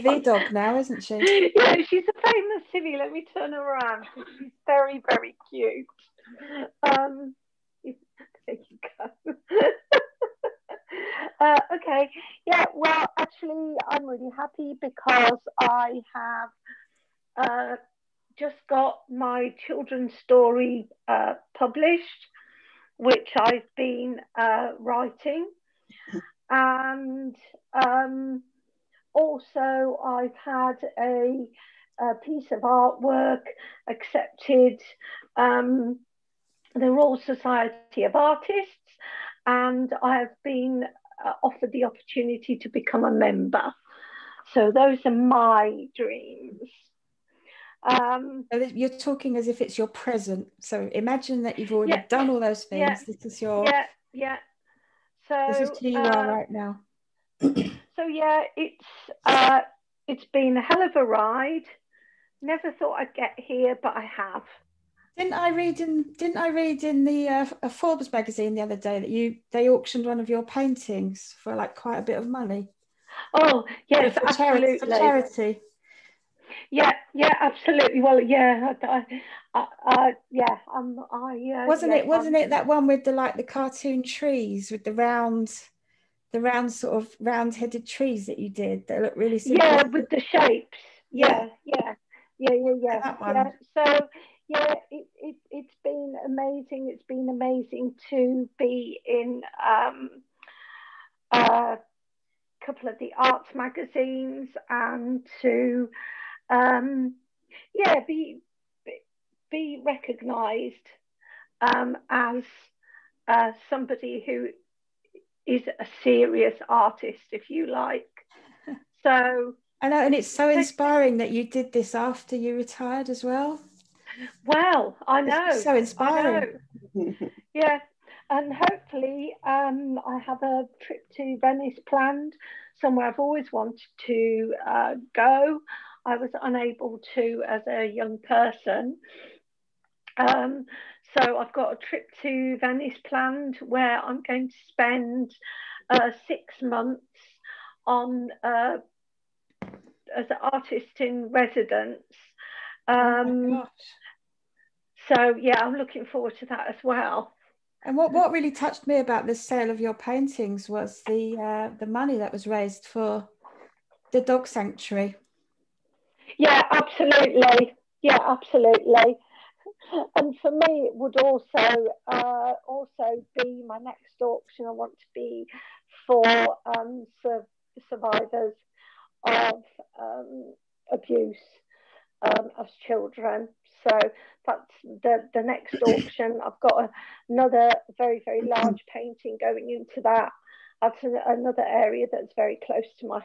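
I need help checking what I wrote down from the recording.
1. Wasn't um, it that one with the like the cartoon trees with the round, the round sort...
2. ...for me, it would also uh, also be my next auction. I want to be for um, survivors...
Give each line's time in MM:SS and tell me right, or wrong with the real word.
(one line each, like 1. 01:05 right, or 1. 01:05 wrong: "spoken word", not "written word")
1. 01:22 right
2. 02:50 right.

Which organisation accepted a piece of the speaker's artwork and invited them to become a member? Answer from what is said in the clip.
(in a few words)
Royal Society of Artists.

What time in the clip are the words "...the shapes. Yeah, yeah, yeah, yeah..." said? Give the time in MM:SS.
01:30.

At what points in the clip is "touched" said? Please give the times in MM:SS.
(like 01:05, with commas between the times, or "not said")
02:38.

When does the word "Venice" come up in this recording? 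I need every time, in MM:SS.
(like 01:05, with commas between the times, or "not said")
02:11, 02:22.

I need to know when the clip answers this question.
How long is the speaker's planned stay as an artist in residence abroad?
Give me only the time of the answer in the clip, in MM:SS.
02:26.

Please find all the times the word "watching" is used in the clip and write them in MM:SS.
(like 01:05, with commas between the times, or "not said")
not said.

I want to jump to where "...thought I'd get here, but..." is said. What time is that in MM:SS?
01:02.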